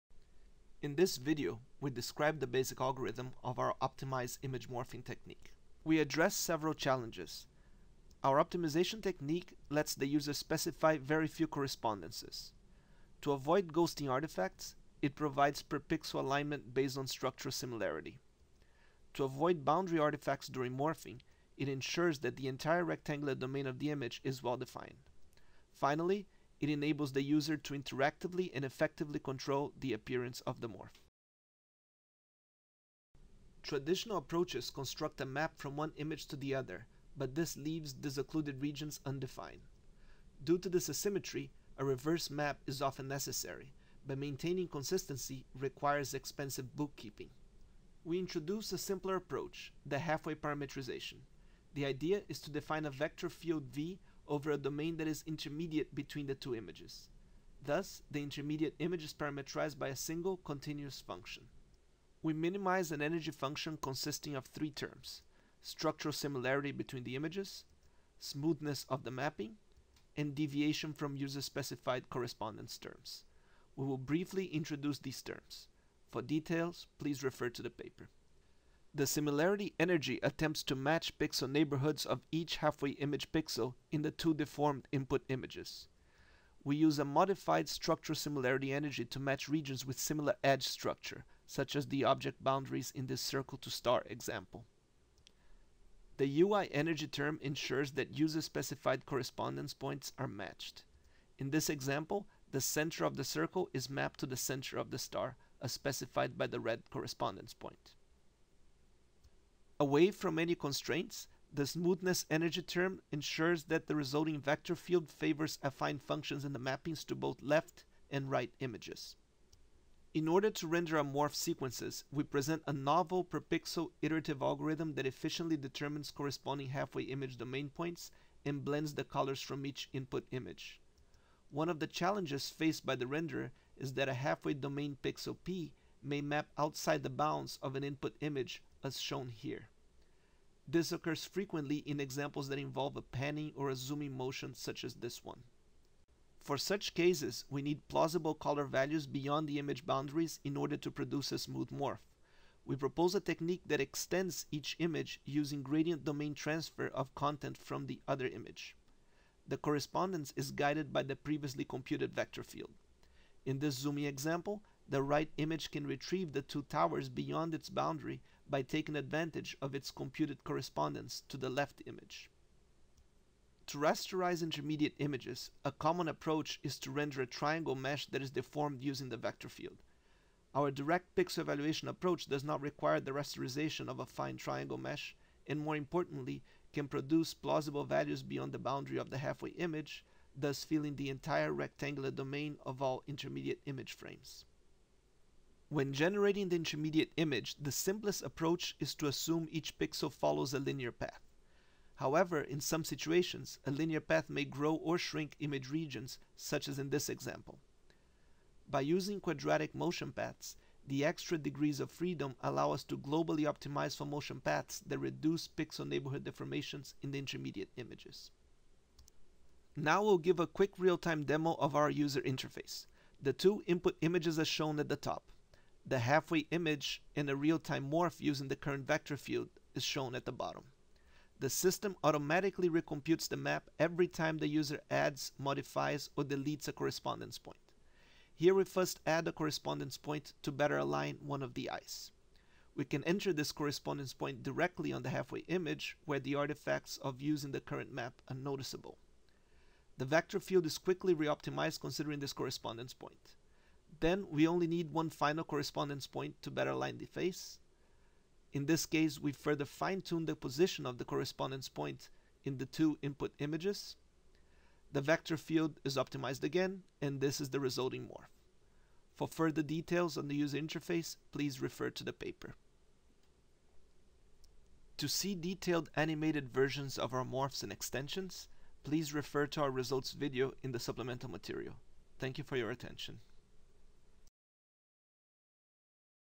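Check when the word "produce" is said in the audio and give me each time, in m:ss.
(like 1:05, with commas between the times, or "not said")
2:30, 3:06.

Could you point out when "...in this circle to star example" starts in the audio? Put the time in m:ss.
1:32.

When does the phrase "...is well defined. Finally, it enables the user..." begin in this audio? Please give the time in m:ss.
0:24.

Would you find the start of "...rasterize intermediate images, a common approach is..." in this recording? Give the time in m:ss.
2:53.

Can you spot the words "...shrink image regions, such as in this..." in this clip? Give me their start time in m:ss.
3:24.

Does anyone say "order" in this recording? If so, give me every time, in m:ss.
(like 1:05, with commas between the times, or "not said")
2:00, 2:30.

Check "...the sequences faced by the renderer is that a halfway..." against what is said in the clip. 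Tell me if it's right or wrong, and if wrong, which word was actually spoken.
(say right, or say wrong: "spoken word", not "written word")
wrong: "challenges", not "sequences".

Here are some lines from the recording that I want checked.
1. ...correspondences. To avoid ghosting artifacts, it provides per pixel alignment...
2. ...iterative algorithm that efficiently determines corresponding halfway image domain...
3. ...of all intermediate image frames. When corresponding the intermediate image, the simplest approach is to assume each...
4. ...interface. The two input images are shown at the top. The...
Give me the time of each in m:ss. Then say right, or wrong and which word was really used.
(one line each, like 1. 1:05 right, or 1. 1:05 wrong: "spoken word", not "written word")
1. 0:11 right
2. 2:04 right
3. 3:12 wrong: "generating", not "corresponding"
4. 3:42 right.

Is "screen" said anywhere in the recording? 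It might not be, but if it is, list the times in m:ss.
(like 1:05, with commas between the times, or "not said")
not said.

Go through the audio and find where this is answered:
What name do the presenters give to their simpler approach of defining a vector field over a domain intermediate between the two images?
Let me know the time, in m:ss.
0:49.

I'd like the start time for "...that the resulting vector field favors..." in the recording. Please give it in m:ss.
1:53.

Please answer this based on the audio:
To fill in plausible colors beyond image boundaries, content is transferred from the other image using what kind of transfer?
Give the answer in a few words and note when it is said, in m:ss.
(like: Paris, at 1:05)
gradient domain transfer, at 2:35.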